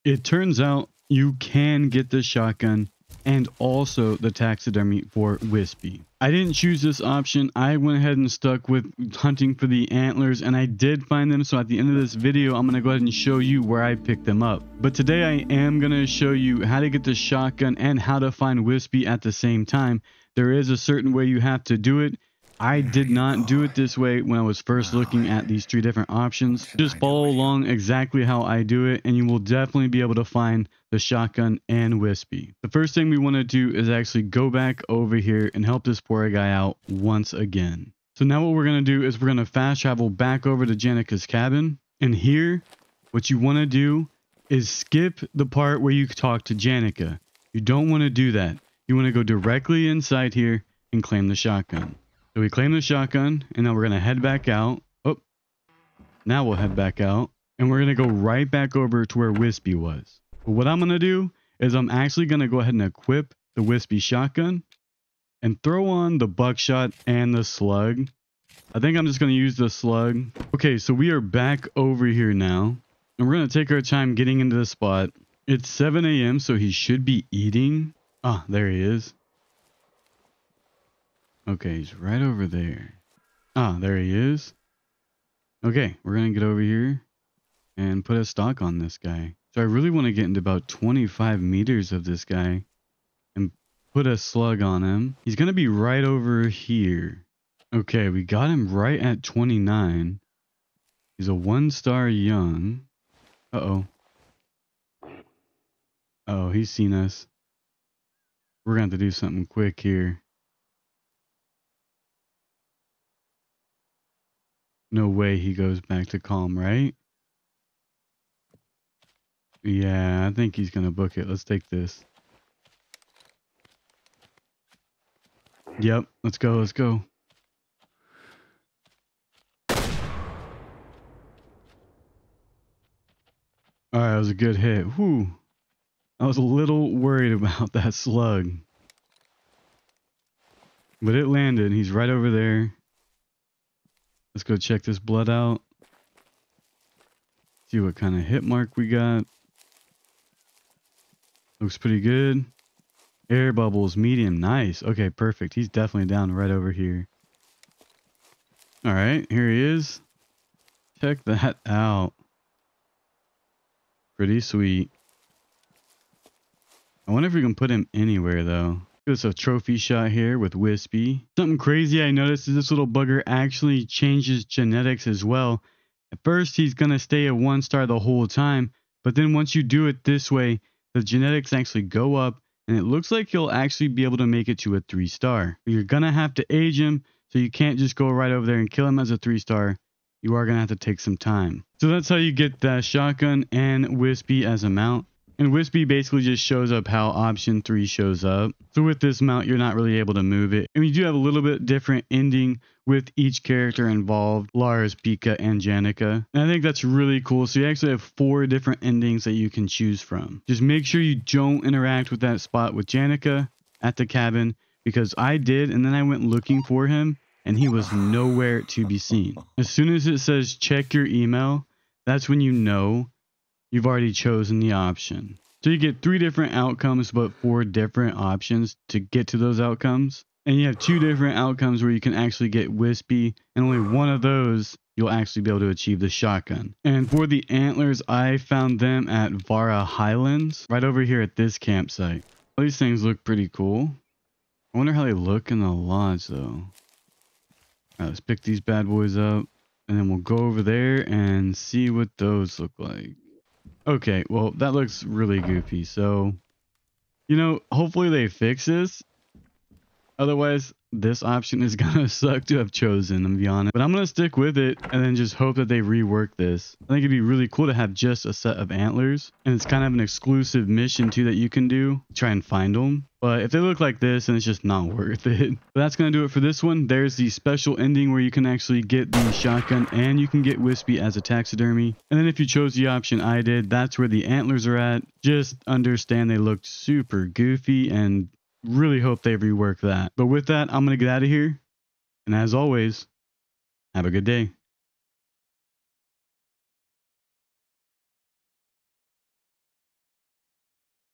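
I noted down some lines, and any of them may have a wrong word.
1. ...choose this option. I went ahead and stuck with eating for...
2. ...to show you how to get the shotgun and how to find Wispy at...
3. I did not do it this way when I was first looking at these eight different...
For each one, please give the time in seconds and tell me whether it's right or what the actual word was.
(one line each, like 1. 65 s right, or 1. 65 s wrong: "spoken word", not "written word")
1. 6 s wrong: "hunting", not "eating"
2. 15 s right
3. 22 s wrong: "three", not "eight".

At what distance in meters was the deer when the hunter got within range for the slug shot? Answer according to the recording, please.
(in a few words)
29.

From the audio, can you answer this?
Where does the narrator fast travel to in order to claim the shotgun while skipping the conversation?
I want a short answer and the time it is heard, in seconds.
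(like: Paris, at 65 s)
Janica's cabin, at 40 s.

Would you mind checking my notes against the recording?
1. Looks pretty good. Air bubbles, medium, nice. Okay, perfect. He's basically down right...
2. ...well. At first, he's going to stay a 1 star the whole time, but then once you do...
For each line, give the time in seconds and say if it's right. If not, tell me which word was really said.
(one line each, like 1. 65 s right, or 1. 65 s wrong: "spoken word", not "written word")
1. 151 s wrong: "definitely", not "basically"
2. 175 s right.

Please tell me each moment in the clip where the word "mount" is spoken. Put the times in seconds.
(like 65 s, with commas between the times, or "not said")
194 s, 199 s.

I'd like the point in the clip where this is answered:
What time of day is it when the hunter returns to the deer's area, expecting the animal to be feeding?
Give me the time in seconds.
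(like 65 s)
75 s.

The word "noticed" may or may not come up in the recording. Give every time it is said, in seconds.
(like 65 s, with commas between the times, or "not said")
172 s.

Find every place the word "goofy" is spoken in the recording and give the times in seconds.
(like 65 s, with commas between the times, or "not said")
255 s, 287 s.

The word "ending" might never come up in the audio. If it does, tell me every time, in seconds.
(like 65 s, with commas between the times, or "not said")
202 s, 208 s, 277 s.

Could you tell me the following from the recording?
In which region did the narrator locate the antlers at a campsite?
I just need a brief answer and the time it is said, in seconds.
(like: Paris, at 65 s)
Vara Highlands, at 239 s.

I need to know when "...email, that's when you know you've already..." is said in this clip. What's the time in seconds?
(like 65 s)
221 s.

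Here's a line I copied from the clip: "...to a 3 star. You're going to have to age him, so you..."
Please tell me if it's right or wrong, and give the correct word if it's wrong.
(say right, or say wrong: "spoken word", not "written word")
right.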